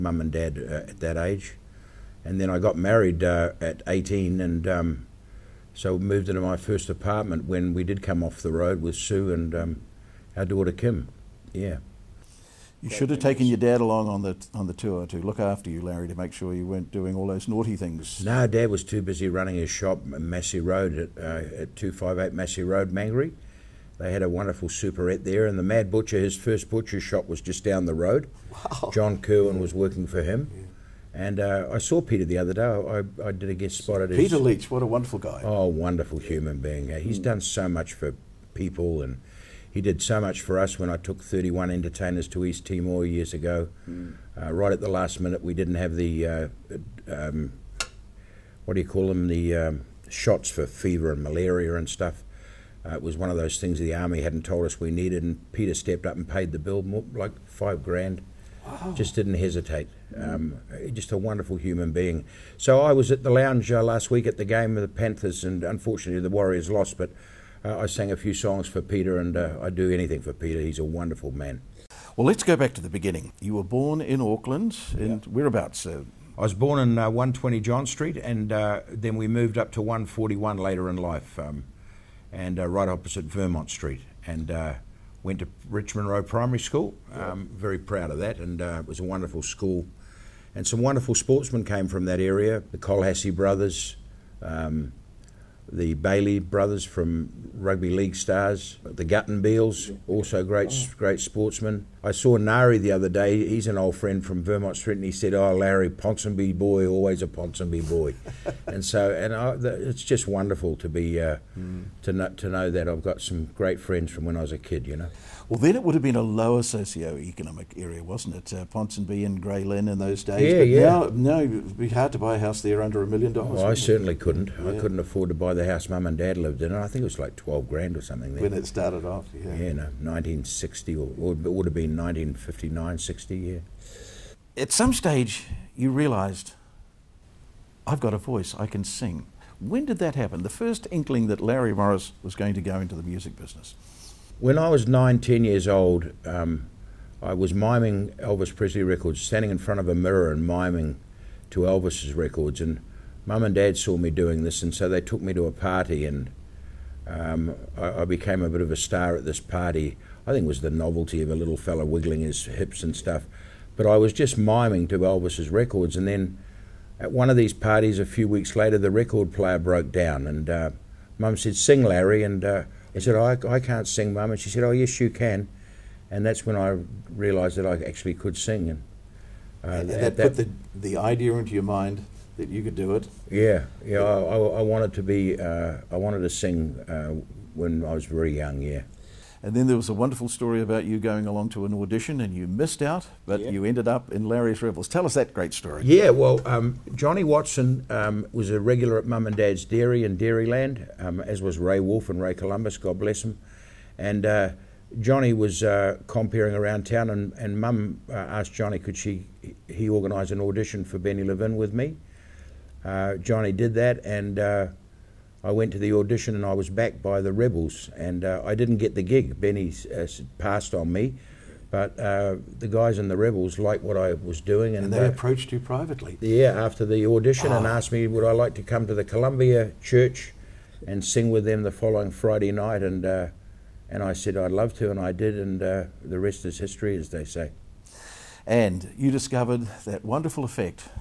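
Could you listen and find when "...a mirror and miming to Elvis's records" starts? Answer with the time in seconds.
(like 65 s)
149 s.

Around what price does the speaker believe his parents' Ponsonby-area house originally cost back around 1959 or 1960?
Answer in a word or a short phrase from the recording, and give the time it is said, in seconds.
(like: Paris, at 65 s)
12 grand, at 127 s.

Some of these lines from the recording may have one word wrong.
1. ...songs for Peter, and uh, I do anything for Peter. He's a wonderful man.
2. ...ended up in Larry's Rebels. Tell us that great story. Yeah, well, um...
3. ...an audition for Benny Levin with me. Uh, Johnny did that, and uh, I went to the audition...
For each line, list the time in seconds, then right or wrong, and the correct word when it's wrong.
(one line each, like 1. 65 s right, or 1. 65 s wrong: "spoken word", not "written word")
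1. 68 s right
2. 193 s right
3. 210 s right.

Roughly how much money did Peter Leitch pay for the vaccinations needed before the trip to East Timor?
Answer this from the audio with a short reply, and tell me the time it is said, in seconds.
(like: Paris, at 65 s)
5 grand, at 57 s.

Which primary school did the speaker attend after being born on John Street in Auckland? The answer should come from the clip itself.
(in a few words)
Richmond Road Primary School.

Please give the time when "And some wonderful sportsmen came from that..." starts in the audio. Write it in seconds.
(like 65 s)
90 s.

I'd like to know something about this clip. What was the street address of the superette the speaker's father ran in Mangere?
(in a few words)
258 Massey Road.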